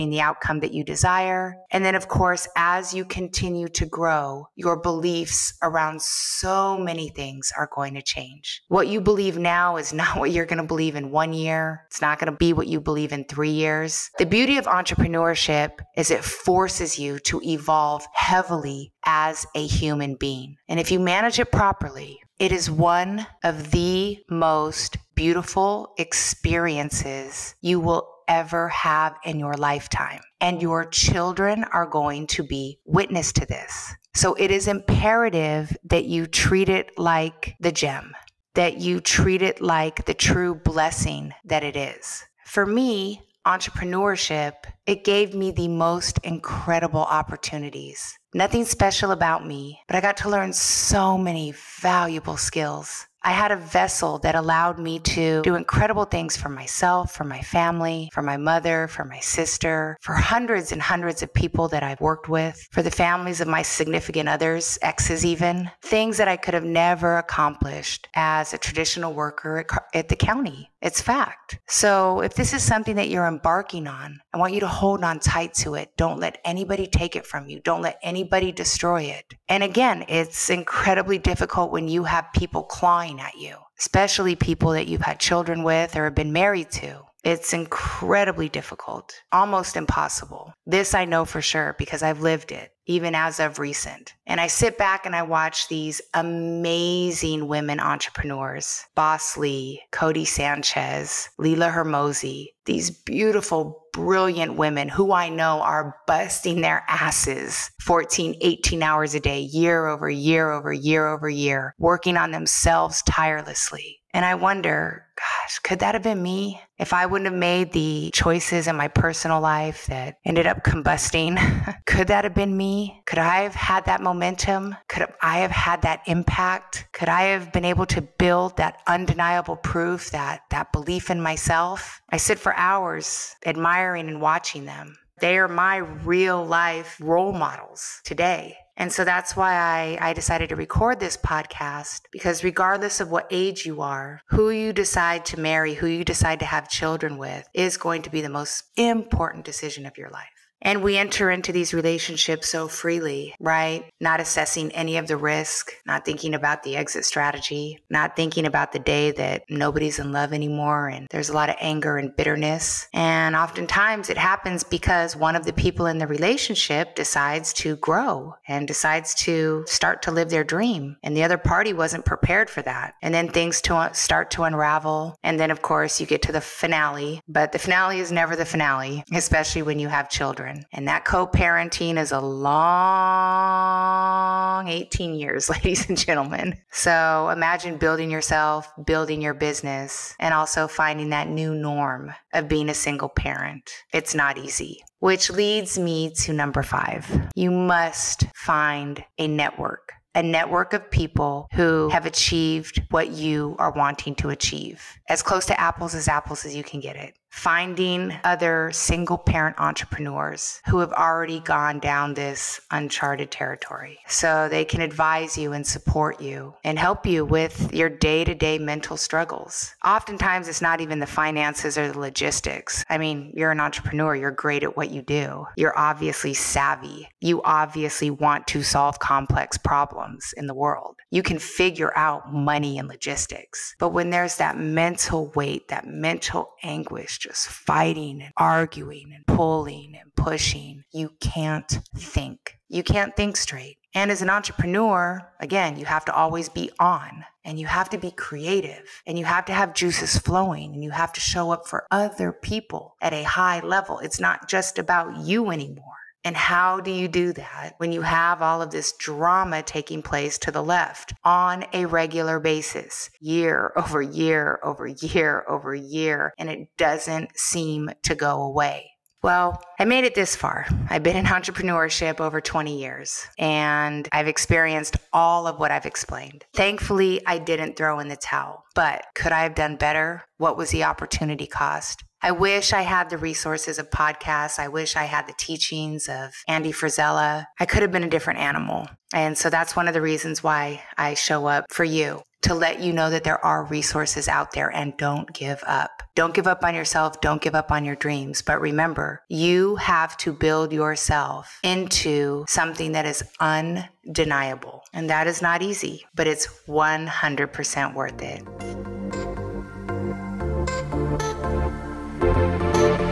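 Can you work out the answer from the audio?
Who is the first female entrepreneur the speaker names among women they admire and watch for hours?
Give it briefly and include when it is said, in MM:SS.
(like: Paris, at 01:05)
Boss Lee, at 01:38.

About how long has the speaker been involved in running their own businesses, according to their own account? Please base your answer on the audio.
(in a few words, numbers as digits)
Over 20 years.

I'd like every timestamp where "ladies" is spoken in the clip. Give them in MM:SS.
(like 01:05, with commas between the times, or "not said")
03:05.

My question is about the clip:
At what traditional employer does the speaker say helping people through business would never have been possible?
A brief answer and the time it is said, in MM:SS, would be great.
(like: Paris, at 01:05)
The county, at 01:10.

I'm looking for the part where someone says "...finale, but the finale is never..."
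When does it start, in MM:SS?
02:56.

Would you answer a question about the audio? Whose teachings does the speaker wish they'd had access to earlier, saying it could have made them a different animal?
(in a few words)
Andy Frisella.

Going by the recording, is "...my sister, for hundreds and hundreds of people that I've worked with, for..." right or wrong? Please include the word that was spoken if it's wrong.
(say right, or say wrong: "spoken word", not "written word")
right.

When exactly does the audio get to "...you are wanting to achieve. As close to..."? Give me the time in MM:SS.
03:23.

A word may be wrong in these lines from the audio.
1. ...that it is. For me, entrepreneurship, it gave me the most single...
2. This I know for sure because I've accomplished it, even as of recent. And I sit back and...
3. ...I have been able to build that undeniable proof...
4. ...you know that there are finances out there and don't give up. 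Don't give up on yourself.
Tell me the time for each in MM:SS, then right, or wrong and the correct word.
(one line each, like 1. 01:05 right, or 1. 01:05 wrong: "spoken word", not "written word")
1. 00:41 wrong: "incredible", not "single"
2. 01:30 wrong: "lived", not "accomplished"
3. 02:07 right
4. 04:52 wrong: "resources", not "finances".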